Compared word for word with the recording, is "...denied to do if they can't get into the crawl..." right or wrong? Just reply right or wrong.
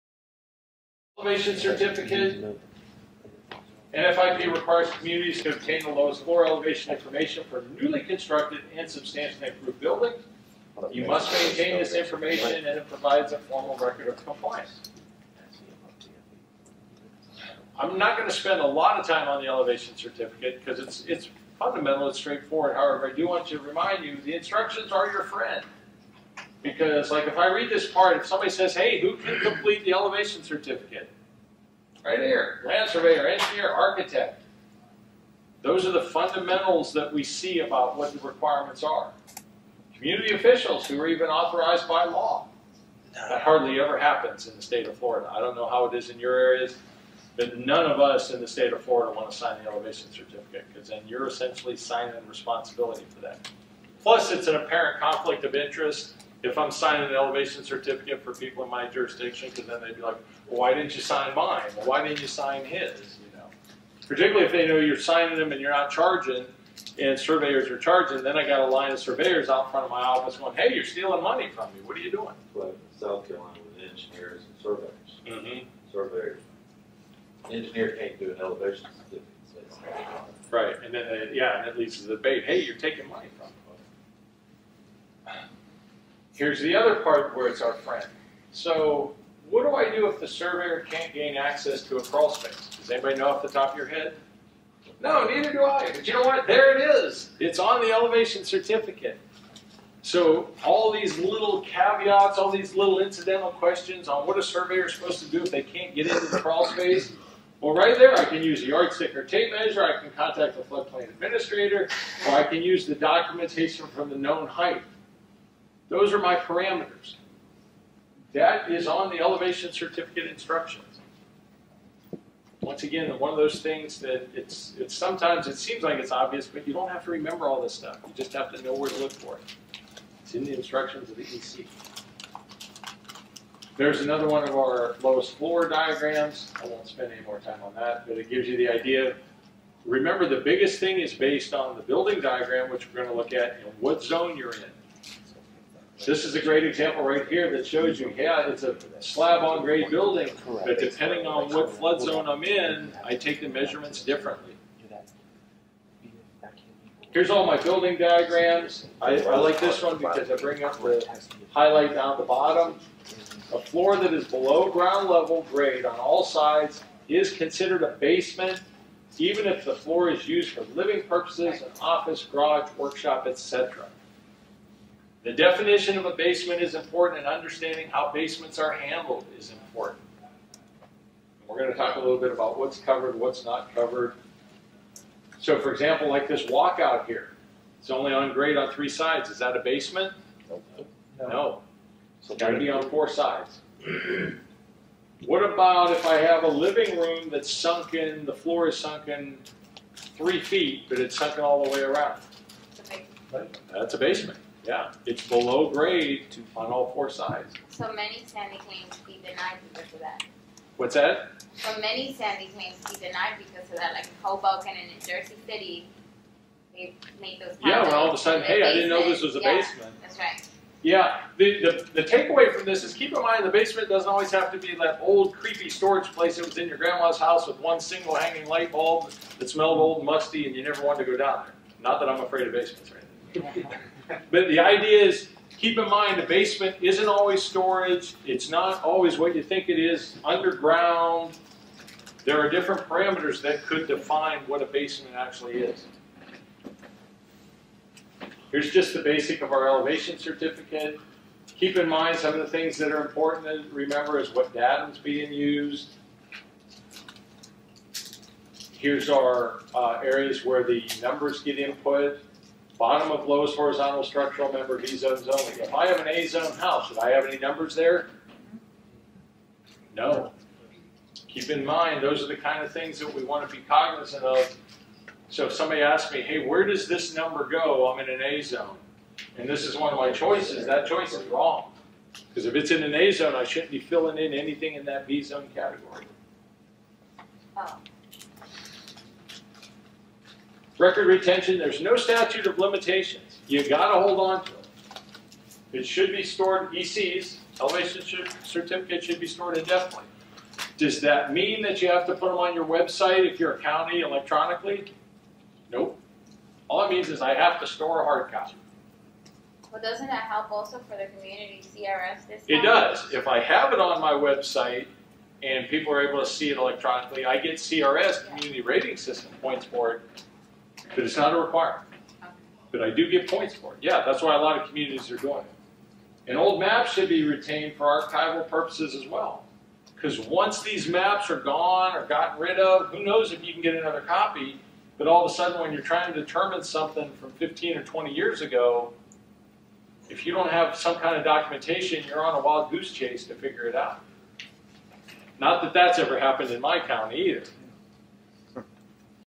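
wrong.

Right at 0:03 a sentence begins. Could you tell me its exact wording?
NFIP requires communities to obtain the lowest floor elevation information for newly constructed and substantially improved buildings.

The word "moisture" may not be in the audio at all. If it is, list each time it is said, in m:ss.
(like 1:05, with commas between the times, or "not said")
not said.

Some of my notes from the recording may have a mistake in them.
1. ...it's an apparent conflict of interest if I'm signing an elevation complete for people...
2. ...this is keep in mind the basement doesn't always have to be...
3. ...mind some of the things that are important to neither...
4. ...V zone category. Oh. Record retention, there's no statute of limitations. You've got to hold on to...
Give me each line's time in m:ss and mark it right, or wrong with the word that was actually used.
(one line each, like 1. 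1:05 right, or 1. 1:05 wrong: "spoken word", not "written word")
1. 0:54 wrong: "certificate", not "complete"
2. 3:42 right
3. 4:11 wrong: "remember", not "neither"
4. 4:45 right.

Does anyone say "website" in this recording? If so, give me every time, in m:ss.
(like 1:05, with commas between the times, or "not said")
5:02, 5:14.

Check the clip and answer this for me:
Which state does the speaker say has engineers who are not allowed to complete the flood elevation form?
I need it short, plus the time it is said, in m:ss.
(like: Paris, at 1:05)
South Carolina, at 1:12.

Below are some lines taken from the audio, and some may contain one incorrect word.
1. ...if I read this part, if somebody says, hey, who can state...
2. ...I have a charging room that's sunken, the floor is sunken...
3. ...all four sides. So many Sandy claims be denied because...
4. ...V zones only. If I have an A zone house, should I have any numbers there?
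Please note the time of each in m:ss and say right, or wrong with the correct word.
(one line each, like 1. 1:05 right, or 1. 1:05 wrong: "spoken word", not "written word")
1. 0:27 wrong: "complete", not "state"
2. 3:16 wrong: "living", not "charging"
3. 3:26 right
4. 4:24 right.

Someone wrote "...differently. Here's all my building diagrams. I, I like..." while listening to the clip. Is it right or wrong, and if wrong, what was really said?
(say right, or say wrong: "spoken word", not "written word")
right.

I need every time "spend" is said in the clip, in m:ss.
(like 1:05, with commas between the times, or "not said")
0:18, 2:16.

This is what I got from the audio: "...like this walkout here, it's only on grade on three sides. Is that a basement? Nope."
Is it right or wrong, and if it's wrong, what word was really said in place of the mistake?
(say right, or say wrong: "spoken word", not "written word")
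right.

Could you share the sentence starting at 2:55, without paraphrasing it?
The definition of a basement is important, and understanding how basements are handled is important.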